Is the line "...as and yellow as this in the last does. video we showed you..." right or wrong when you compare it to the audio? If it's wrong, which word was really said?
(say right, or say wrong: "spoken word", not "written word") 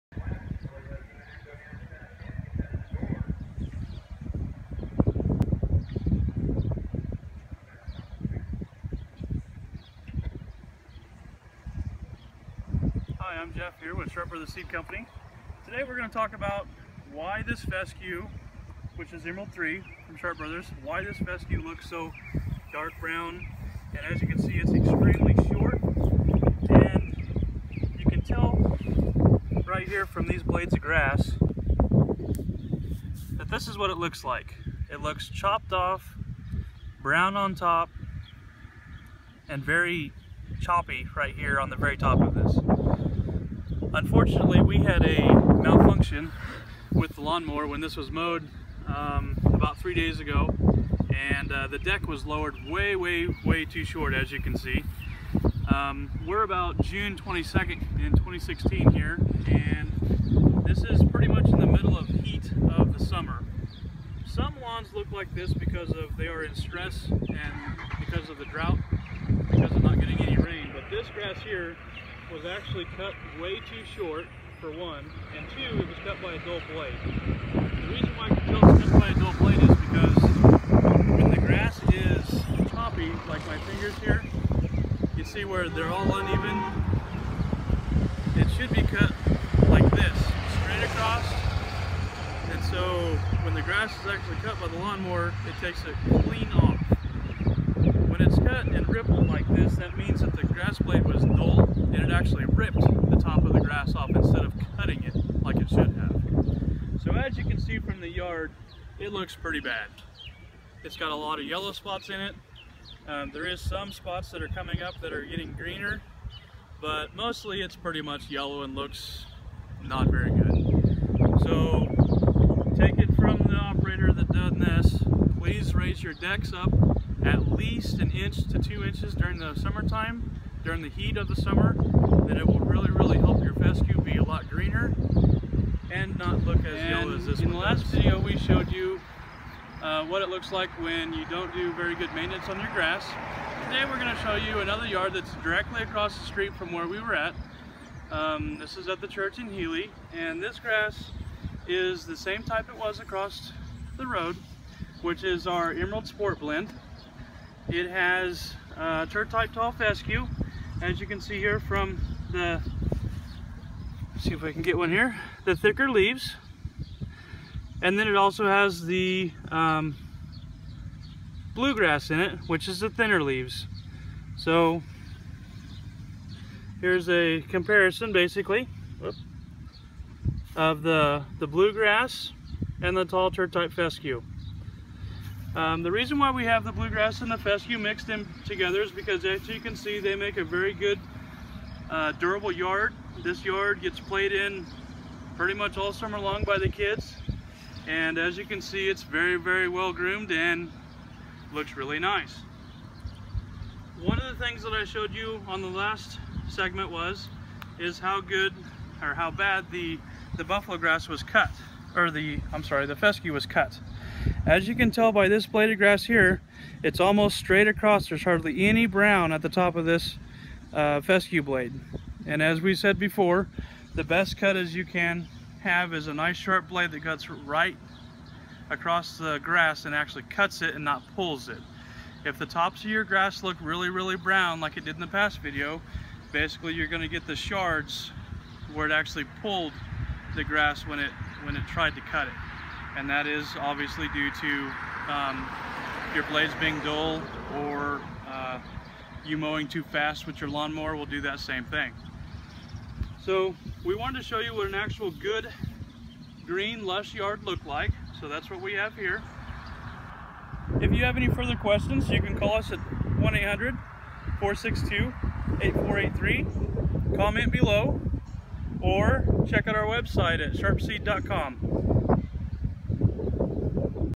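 right.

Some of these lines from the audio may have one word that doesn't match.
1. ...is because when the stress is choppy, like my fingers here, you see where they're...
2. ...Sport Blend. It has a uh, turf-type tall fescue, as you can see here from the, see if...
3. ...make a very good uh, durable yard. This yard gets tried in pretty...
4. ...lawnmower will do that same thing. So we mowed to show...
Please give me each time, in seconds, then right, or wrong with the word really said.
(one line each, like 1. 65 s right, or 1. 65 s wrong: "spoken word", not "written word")
1. 79 s wrong: "grass", not "stress"
2. 156 s right
3. 190 s wrong: "played", not "tried"
4. 250 s wrong: "wanted", not "mowed".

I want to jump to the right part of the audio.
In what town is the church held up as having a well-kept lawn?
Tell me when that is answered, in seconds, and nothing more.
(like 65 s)
149 s.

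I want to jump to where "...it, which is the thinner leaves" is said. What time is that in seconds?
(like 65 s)
172 s.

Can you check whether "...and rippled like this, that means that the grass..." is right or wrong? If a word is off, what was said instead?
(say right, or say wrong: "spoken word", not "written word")
right.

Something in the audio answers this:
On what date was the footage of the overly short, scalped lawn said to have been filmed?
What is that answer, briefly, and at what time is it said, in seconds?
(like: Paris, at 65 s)
June 22nd, at 56 s.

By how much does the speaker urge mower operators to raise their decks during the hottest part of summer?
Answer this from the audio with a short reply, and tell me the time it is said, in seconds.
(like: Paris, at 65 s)
1 to 2 inches, at 127 s.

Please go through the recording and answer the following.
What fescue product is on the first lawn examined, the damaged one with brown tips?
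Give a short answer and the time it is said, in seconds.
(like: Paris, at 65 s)
Emerald 3, at 19 s.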